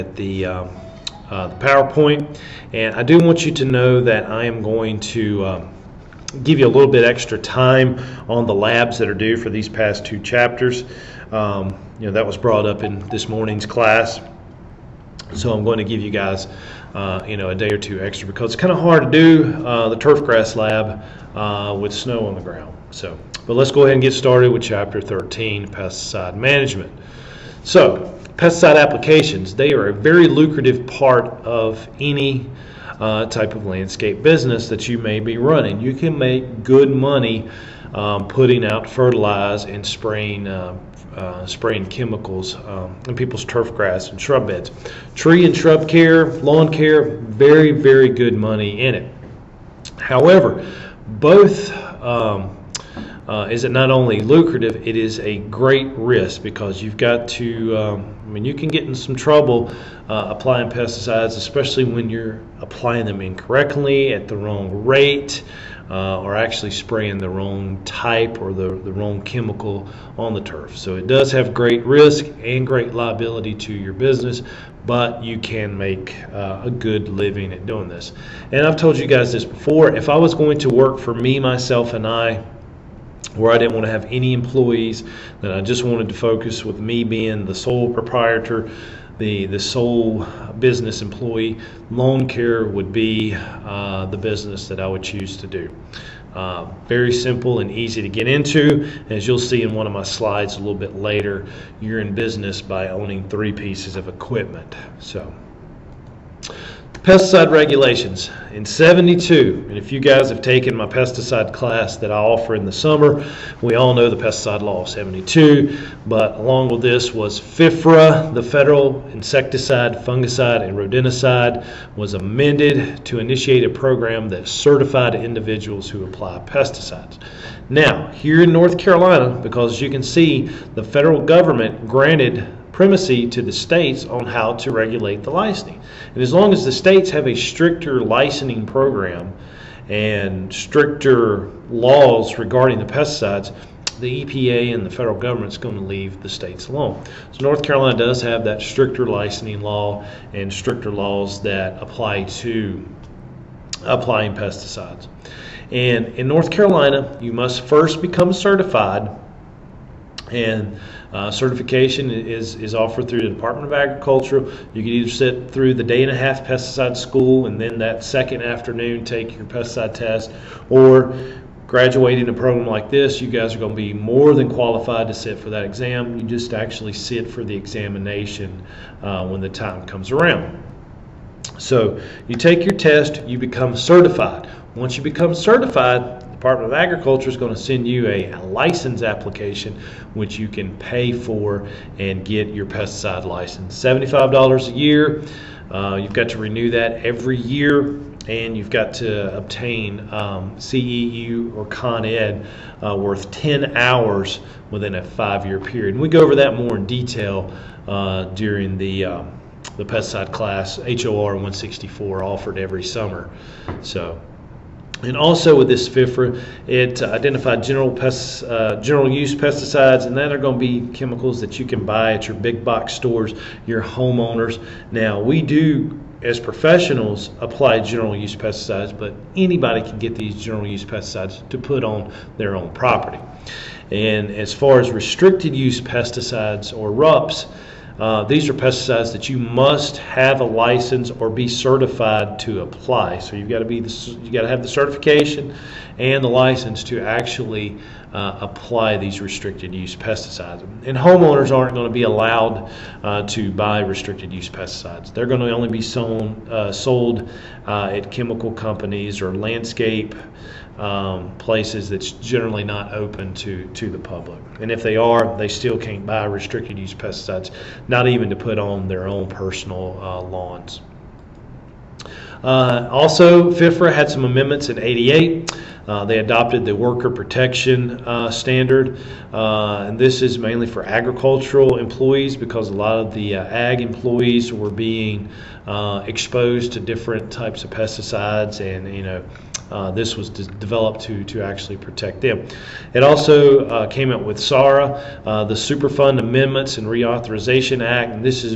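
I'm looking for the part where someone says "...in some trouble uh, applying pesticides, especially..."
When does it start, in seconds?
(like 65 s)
58 s.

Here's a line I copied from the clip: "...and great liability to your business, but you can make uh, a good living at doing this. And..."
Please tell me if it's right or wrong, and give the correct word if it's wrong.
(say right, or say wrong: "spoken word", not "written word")
right.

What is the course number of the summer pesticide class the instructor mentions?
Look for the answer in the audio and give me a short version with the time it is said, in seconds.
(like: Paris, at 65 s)
HOR 164, at 210 s.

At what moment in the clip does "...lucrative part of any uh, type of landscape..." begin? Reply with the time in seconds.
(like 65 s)
30 s.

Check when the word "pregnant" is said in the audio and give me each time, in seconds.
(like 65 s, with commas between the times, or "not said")
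not said.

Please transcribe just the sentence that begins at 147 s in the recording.
So North Carolina does have that stricter licensing law and stricter laws that apply to applying pesticides.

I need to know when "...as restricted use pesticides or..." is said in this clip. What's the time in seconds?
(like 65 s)
234 s.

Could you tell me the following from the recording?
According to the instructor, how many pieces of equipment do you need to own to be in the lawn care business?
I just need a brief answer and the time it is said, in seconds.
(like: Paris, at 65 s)
3, at 103 s.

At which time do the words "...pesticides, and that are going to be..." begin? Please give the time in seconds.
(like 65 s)
219 s.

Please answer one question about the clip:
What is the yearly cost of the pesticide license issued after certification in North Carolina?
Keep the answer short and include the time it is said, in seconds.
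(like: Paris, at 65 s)
$75, at 193 s.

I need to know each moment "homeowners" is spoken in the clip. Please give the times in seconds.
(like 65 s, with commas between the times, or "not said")
223 s, 250 s.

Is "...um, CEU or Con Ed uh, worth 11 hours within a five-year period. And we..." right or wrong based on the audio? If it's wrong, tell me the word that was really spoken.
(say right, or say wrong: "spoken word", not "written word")
wrong: "10", not "11".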